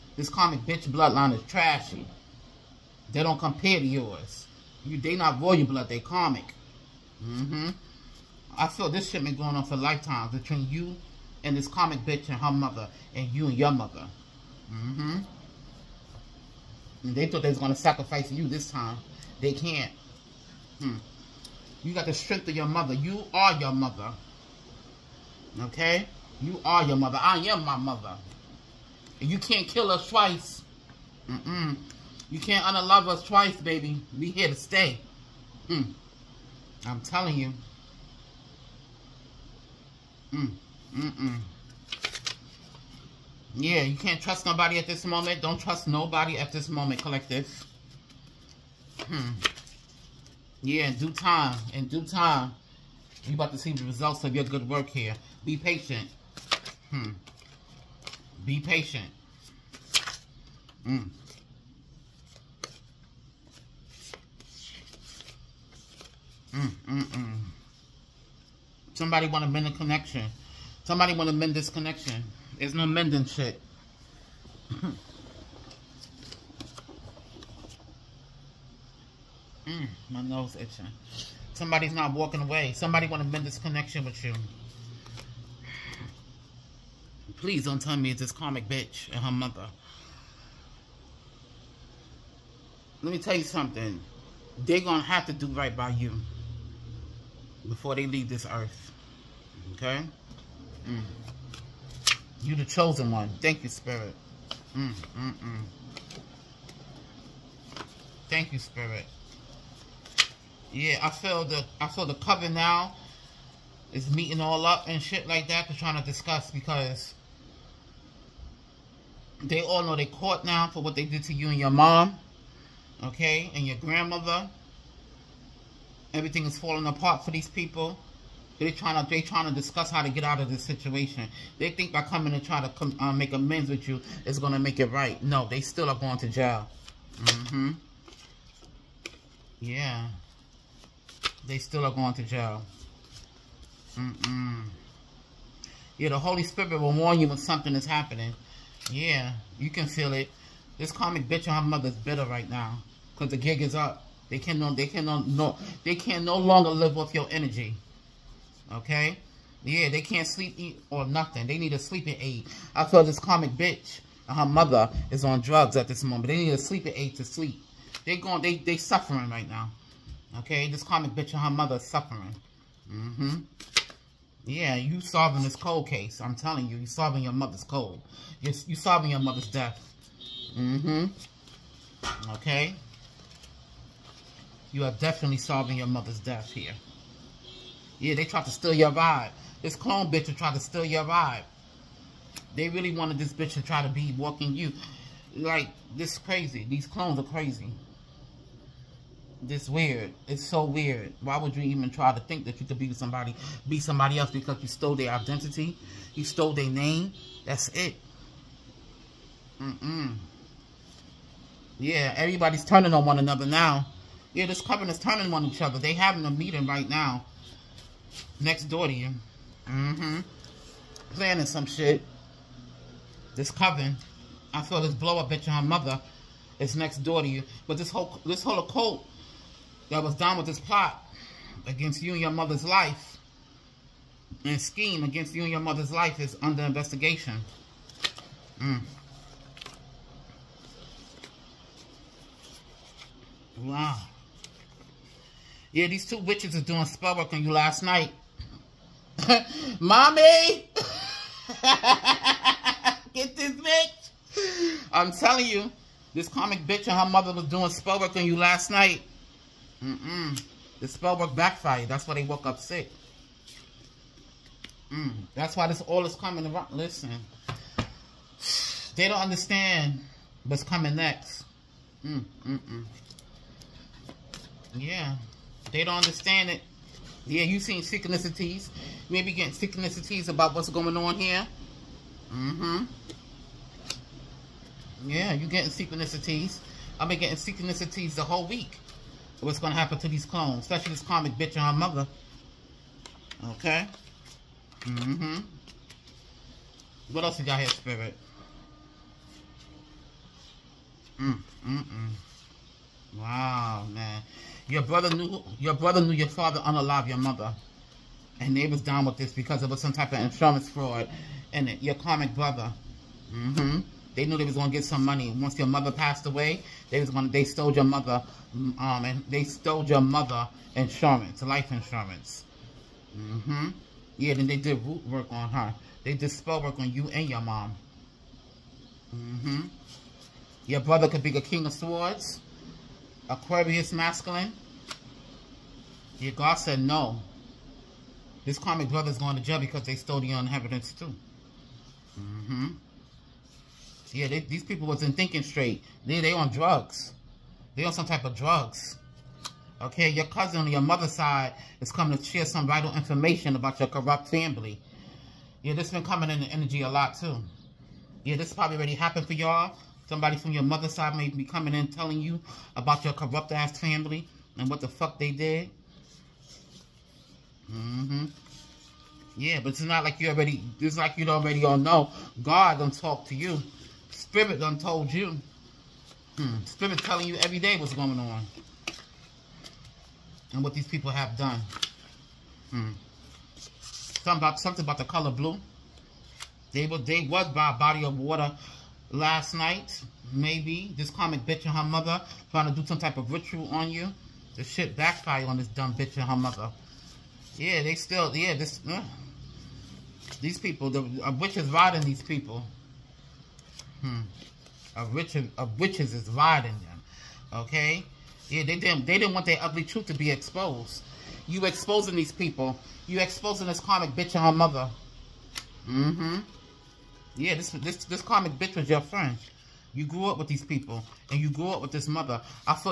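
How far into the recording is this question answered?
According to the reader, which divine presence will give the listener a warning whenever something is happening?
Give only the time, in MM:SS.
02:26.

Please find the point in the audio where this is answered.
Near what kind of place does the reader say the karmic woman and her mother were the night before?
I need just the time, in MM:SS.
06:27.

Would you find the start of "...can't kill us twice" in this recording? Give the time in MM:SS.
00:29.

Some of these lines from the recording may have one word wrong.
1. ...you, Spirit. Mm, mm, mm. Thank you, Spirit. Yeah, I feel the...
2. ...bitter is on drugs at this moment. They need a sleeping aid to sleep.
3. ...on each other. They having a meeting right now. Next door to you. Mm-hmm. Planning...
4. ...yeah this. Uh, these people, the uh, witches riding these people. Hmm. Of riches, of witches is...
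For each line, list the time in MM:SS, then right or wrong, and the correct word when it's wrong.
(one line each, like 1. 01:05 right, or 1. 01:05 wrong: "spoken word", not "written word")
1. 01:43 right
2. 02:44 wrong: "mother", not "bitter"
3. 03:35 right
4. 06:38 right.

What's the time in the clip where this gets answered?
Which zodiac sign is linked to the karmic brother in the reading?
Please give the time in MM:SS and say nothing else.
05:33.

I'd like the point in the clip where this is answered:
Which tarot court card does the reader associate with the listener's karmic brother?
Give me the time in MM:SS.
05:31.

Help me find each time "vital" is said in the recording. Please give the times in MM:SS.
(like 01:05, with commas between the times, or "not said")
05:52.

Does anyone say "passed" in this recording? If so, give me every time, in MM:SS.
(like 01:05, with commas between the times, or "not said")
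05:15.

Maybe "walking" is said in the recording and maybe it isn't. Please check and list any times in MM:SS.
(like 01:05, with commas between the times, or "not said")
01:22, 03:14.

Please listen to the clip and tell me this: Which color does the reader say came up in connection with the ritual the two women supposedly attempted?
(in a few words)
Blue.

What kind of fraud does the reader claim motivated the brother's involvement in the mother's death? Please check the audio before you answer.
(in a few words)
Insurance fraud.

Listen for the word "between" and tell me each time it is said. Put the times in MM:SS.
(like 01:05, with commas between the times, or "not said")
00:10.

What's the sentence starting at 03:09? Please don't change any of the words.
This clone bitch will try to steal your vibe.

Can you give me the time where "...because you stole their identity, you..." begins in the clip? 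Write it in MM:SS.
03:24.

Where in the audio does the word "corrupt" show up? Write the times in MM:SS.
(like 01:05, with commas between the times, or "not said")
05:53, 06:03.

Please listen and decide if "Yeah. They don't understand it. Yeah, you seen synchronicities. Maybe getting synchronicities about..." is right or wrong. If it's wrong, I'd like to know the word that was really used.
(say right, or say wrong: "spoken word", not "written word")
right.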